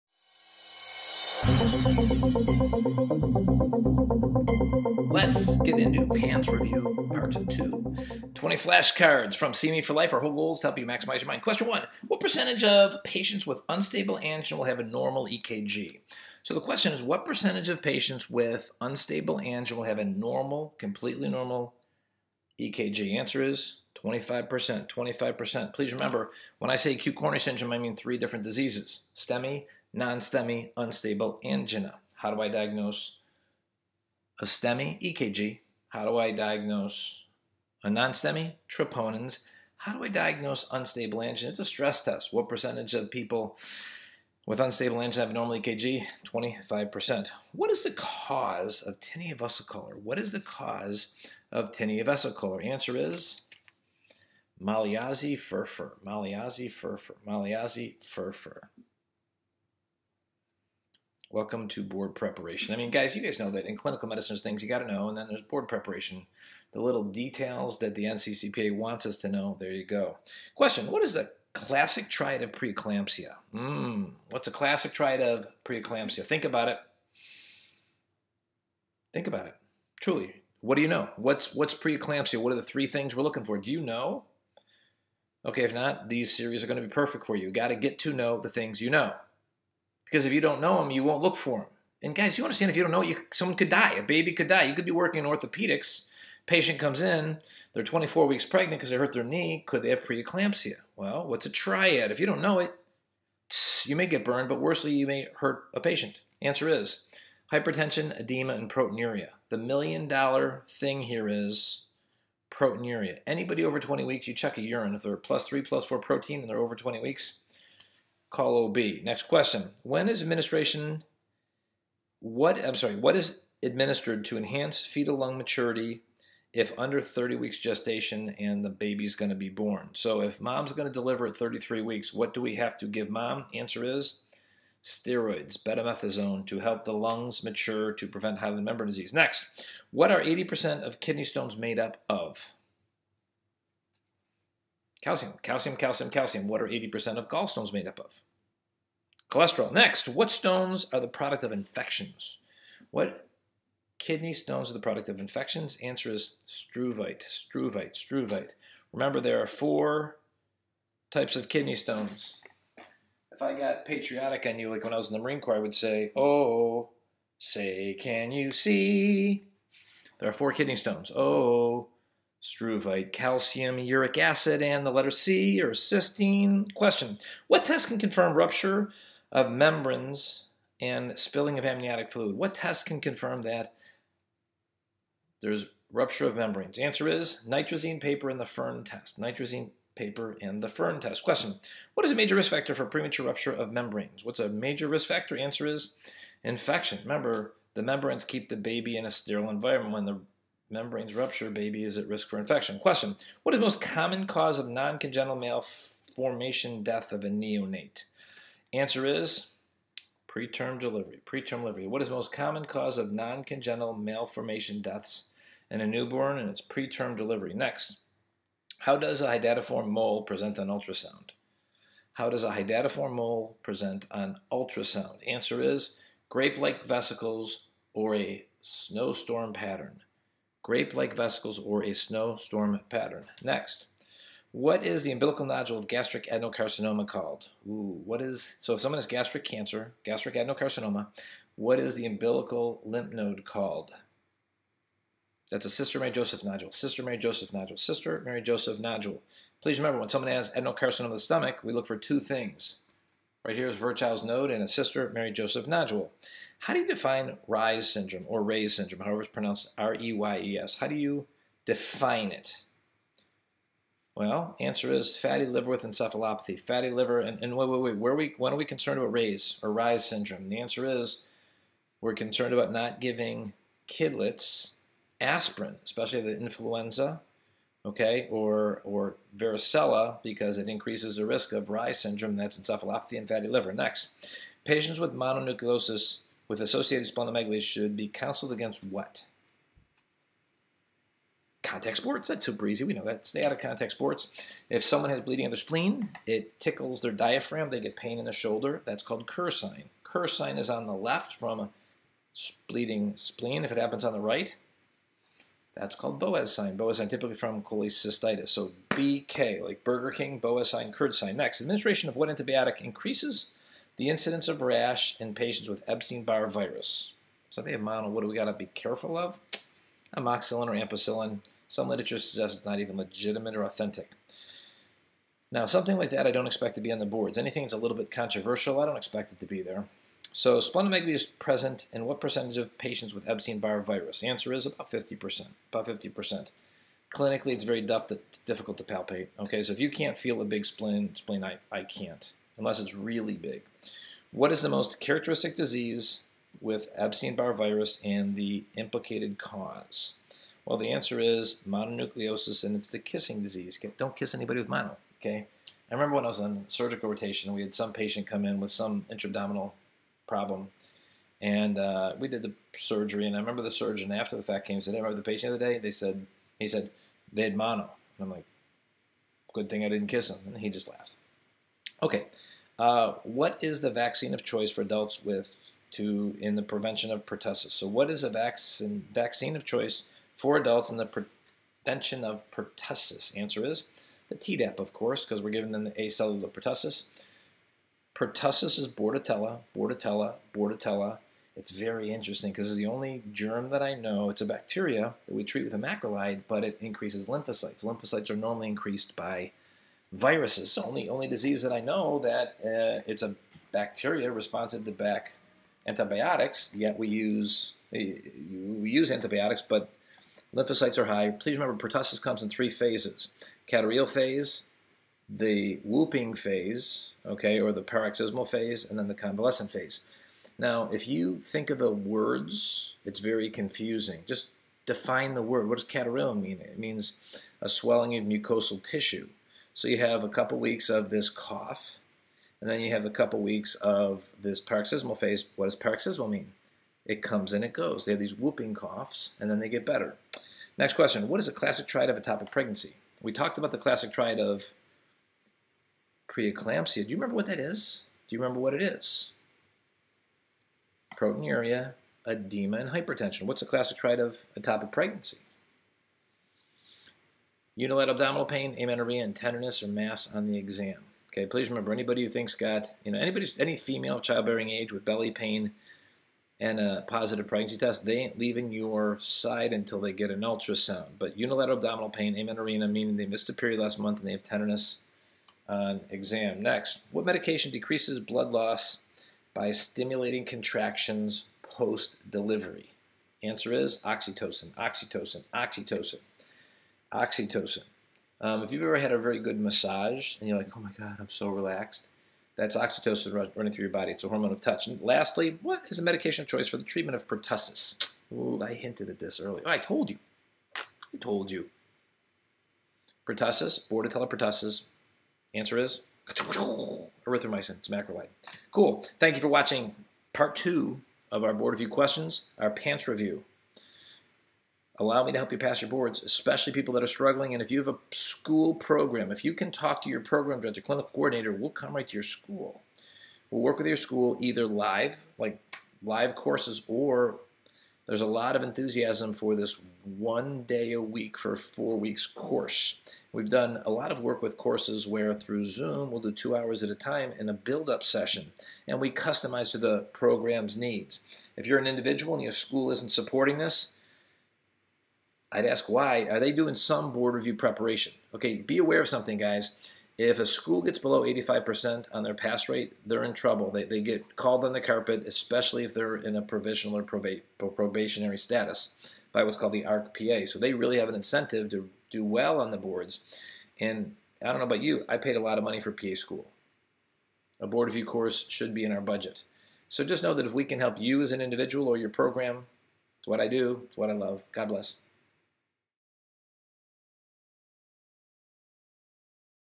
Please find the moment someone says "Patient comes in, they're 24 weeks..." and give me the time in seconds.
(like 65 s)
96 s.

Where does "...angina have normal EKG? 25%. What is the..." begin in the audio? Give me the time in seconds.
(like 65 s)
45 s.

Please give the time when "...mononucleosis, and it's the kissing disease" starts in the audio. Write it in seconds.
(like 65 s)
351 s.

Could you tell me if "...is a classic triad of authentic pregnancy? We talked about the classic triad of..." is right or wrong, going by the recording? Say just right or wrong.
wrong.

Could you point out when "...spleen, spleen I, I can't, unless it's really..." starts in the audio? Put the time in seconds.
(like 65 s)
340 s.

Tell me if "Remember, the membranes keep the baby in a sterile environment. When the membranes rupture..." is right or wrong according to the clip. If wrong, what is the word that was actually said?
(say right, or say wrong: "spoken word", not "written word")
right.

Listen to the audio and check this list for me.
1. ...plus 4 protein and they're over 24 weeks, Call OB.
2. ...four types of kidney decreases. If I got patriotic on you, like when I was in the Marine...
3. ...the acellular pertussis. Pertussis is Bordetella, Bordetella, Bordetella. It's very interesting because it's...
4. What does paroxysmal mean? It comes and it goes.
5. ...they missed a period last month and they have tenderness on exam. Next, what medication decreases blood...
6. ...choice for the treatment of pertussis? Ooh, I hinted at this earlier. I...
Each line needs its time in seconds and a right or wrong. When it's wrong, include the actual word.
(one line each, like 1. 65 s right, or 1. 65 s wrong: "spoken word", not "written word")
1. 115 s wrong: "20", not "24"
2. 159 s wrong: "stones", not "decreases"
3. 385 s right
4. 435 s right
5. 473 s right
6. 496 s right.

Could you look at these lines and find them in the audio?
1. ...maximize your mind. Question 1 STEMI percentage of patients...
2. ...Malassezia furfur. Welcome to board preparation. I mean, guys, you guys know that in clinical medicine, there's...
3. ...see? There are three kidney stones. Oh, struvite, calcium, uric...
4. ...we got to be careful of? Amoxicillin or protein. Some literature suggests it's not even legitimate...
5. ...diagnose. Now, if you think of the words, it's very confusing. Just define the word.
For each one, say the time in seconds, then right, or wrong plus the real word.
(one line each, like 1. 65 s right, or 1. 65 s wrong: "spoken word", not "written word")
1. 10 s wrong: "What", not "STEMI"
2. 57 s right
3. 168 s wrong: "four", not "three"
4. 318 s wrong: "ampicillin", not "protein"
5. 419 s wrong: "phase", not "diagnose".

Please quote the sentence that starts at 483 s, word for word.
Answer is oxytocin, oxytocin, oxytocin, oxytocin.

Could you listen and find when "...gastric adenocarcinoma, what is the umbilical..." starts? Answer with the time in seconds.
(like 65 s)
240 s.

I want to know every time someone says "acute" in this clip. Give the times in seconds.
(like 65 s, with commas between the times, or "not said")
26 s.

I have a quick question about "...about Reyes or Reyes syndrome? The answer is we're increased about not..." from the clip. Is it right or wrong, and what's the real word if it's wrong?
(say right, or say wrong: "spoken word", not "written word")
wrong: "concerned", not "increased".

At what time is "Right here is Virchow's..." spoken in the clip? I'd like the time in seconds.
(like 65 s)
253 s.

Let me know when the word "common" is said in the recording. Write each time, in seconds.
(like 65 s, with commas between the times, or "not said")
203 s, 212 s.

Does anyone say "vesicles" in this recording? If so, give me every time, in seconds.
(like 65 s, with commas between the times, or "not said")
226 s, 231 s.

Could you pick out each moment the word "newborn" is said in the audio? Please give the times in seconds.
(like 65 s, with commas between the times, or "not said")
215 s.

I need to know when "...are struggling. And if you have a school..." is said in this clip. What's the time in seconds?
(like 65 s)
517 s.